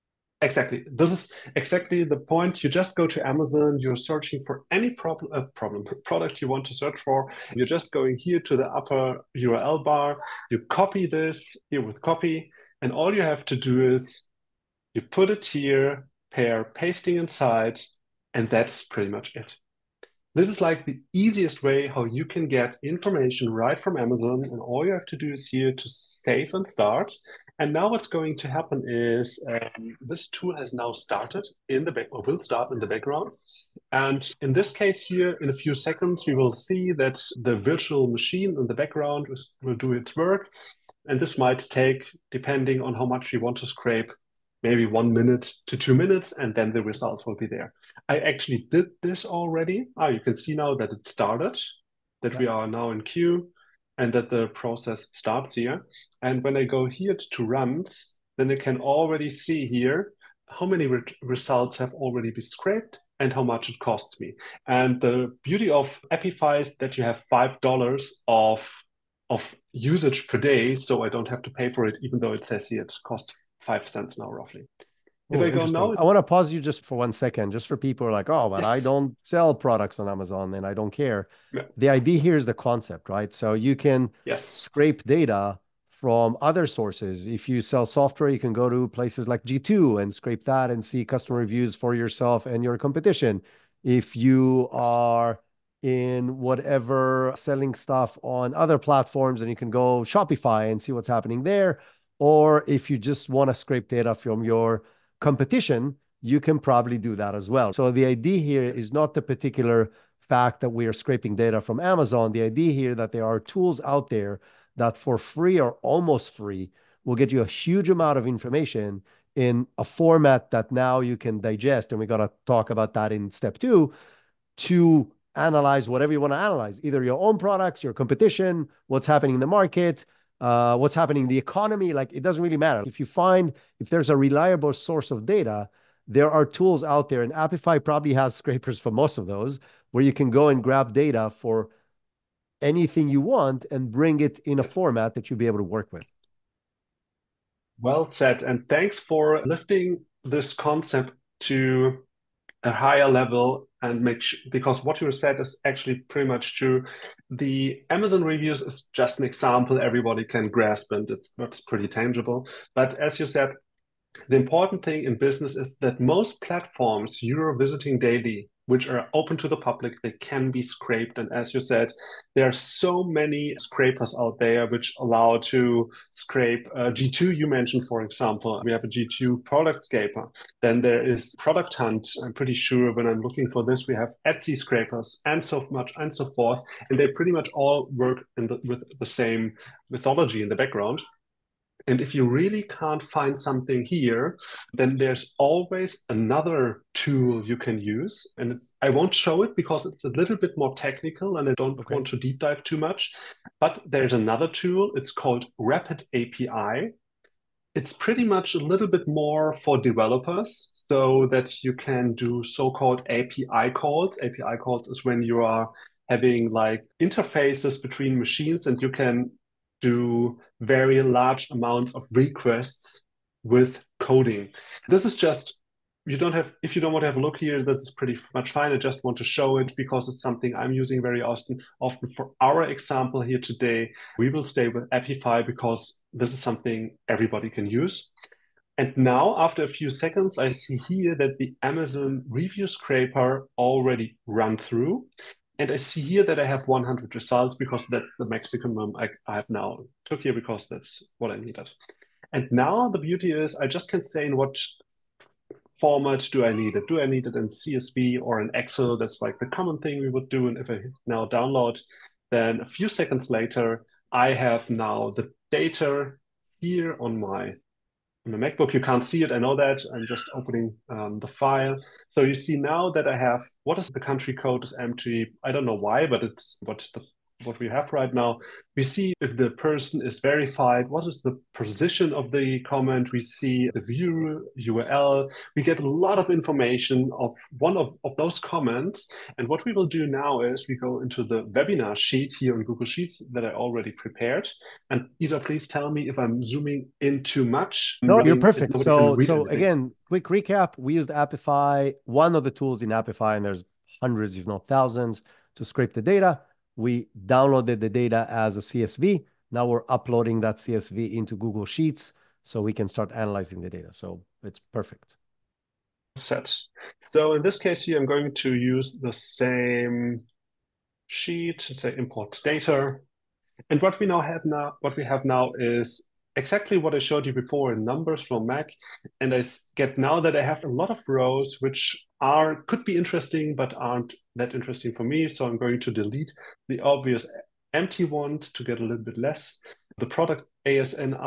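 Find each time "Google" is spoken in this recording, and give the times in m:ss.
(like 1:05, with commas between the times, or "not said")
4:52, 5:11.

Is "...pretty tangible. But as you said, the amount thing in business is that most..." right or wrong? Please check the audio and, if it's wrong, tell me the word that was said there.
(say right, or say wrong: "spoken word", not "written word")
wrong: "important", not "amount".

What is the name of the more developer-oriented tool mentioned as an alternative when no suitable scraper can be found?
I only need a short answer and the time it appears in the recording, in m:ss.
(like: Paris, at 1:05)
Rapid API, at 3:25.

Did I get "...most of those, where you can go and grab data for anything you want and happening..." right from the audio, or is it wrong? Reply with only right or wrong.
wrong.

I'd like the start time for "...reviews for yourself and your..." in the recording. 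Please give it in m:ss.
1:31.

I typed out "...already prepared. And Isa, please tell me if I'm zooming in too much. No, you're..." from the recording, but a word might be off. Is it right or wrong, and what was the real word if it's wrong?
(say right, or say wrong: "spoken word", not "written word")
right.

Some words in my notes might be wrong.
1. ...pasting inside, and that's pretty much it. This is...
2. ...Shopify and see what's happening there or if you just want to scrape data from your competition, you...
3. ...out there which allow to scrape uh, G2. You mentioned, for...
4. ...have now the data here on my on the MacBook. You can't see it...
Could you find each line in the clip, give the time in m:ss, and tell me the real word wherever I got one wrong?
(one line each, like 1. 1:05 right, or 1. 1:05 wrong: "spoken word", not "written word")
1. 0:16 right
2. 1:40 right
3. 2:54 right
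4. 4:24 right.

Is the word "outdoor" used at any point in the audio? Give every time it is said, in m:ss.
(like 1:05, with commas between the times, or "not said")
not said.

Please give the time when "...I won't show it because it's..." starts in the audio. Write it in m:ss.
3:18.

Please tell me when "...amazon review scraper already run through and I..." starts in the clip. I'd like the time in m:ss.
4:01.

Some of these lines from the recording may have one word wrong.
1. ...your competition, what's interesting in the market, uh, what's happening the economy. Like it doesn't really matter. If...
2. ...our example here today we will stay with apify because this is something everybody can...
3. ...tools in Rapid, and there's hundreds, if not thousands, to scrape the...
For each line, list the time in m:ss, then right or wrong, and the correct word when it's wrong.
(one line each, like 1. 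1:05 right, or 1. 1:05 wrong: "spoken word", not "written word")
1. 2:07 wrong: "happening", not "interesting"
2. 3:52 right
3. 5:02 wrong: "Apify", not "Rapid".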